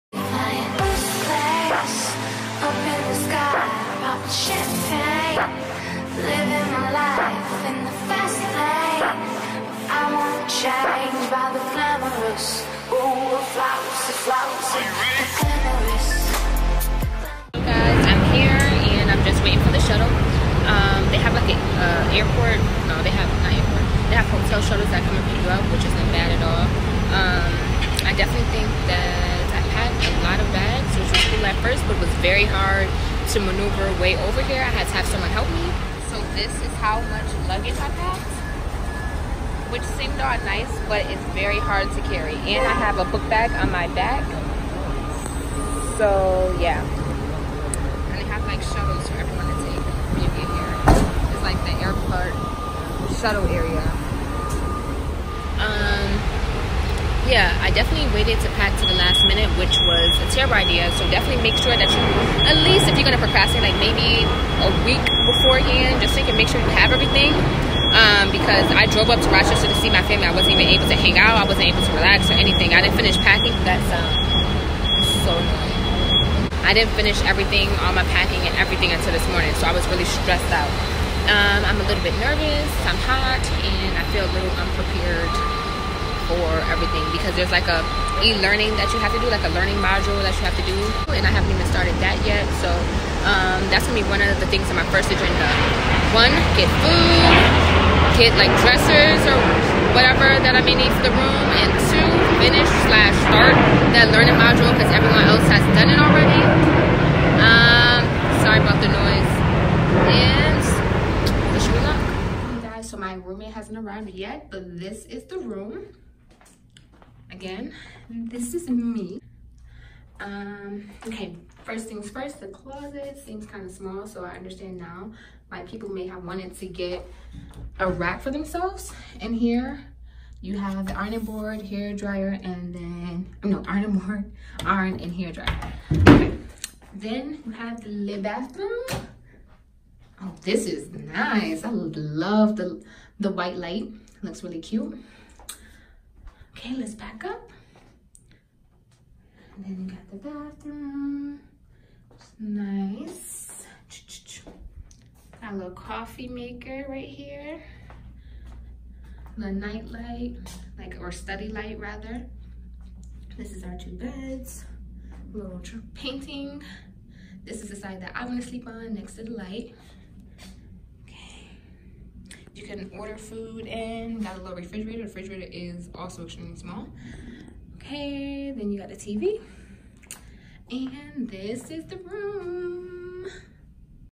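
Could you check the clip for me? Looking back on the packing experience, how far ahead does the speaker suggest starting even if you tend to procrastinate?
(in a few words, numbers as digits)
a week beforehand.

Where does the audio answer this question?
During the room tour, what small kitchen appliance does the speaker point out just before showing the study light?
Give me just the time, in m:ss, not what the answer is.
2:35.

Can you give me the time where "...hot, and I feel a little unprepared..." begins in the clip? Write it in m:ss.
1:23.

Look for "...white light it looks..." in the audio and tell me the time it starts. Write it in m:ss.
2:23.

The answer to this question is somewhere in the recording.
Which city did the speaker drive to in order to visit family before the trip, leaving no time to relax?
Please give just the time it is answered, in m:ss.
1:09.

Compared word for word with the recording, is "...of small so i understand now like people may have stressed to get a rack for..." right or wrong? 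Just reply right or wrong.
wrong.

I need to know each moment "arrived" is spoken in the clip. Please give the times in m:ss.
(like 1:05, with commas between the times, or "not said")
1:53.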